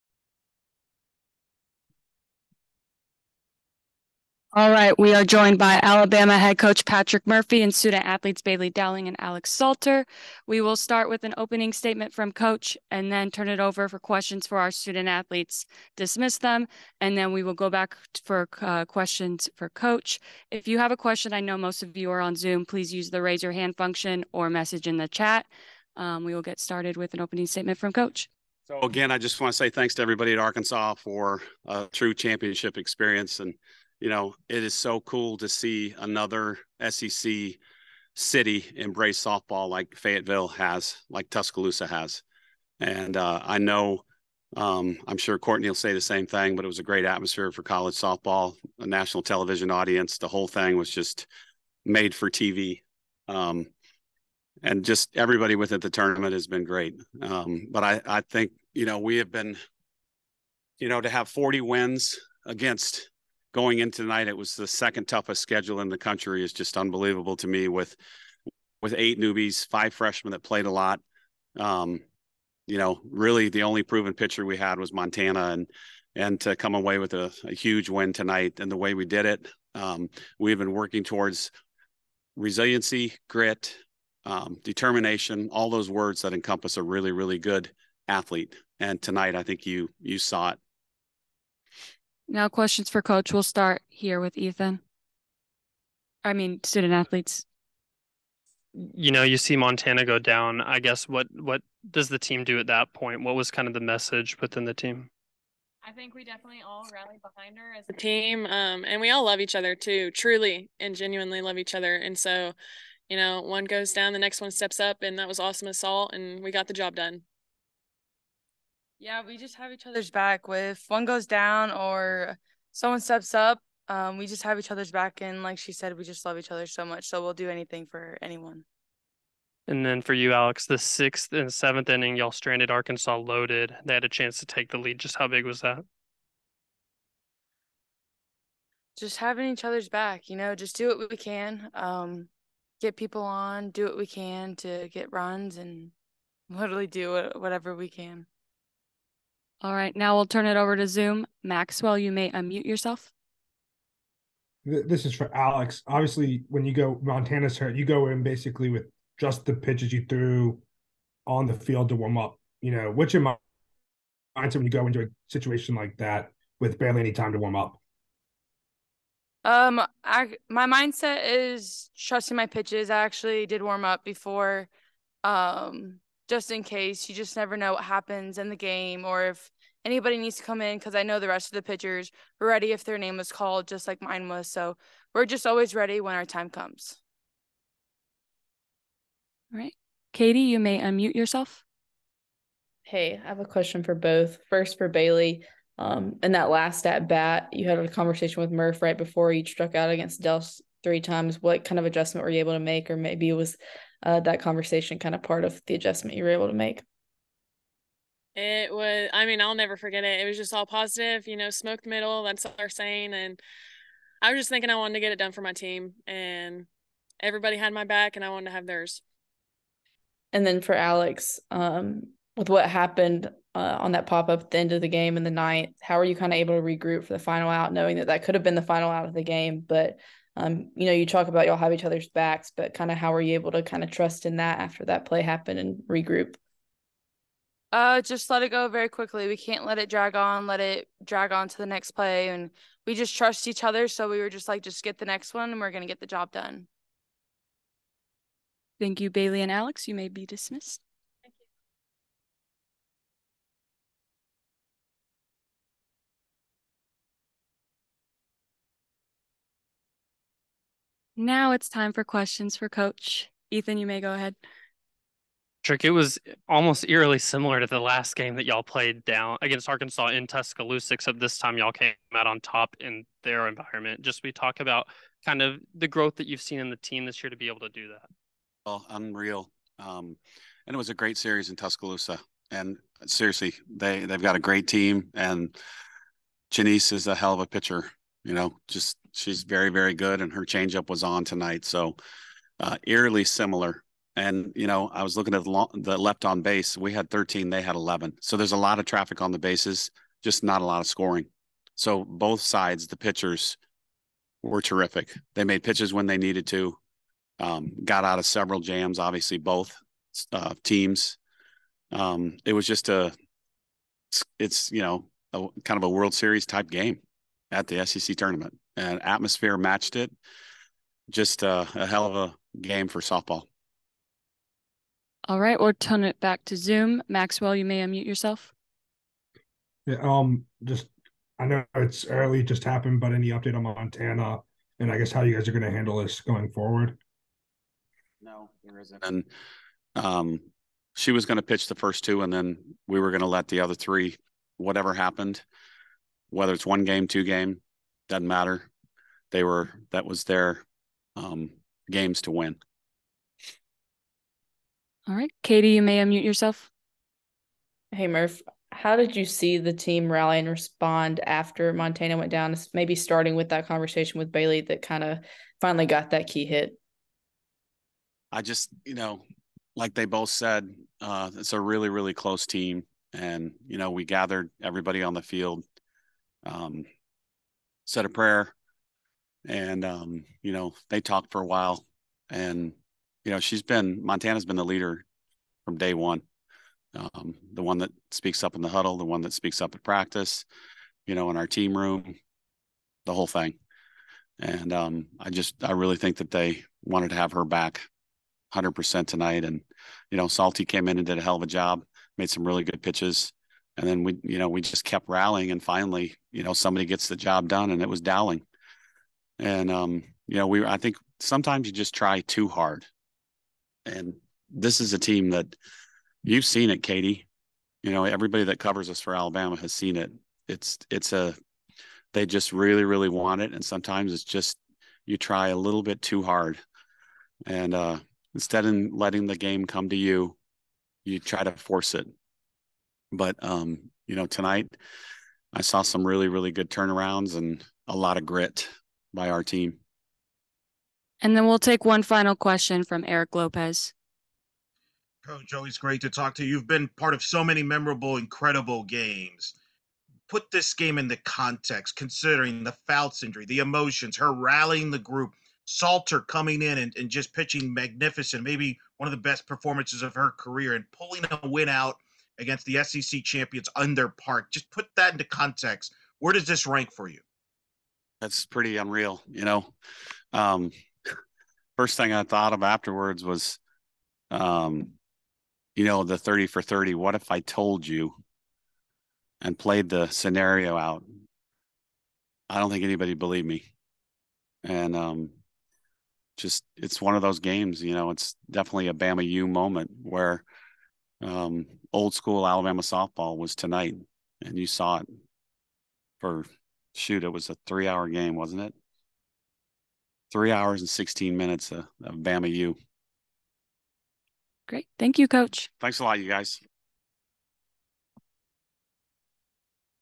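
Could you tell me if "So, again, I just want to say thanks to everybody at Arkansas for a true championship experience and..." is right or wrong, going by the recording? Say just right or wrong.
right.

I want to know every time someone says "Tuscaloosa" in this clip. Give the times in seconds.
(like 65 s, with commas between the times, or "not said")
41 s, 270 s, 281 s.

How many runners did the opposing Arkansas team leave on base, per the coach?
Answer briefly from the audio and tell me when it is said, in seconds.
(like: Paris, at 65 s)
11, at 297 s.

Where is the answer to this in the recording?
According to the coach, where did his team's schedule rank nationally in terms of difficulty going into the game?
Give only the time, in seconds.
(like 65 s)
64 s.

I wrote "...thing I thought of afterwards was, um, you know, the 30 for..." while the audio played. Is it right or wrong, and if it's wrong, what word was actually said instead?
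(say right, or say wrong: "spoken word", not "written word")
right.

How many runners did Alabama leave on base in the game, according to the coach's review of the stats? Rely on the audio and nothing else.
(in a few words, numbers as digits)
13.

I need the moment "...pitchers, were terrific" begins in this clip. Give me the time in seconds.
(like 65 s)
302 s.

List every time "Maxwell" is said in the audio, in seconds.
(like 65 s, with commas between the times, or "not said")
151 s, 327 s.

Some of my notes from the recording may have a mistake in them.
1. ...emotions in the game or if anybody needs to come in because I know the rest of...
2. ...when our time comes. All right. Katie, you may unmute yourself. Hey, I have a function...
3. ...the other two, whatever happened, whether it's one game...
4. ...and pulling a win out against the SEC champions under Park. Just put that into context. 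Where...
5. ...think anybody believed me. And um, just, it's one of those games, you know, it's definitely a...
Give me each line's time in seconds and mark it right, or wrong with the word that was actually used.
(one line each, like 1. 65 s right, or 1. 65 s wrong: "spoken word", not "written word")
1. 177 s wrong: "happens", not "emotions"
2. 185 s wrong: "question", not "function"
3. 343 s wrong: "three", not "two"
4. 460 s right
5. 482 s right.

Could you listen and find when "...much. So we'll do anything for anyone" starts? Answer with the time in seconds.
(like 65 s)
126 s.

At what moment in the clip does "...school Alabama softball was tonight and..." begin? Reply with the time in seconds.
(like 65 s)
492 s.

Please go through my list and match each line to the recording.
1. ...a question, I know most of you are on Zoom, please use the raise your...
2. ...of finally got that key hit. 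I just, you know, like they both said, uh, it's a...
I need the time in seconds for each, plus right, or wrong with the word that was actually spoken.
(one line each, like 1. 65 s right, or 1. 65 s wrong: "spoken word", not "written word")
1. 20 s right
2. 365 s right.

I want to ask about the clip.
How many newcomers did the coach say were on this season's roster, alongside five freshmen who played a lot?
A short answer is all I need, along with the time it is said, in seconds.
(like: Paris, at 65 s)
8, at 68 s.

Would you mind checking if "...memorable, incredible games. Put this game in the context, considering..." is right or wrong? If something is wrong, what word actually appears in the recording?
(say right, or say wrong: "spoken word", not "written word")
right.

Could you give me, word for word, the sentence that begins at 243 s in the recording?
So we were just like, just get the next one and we're going to get the job done.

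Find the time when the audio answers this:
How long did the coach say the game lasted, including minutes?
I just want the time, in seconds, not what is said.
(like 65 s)
500 s.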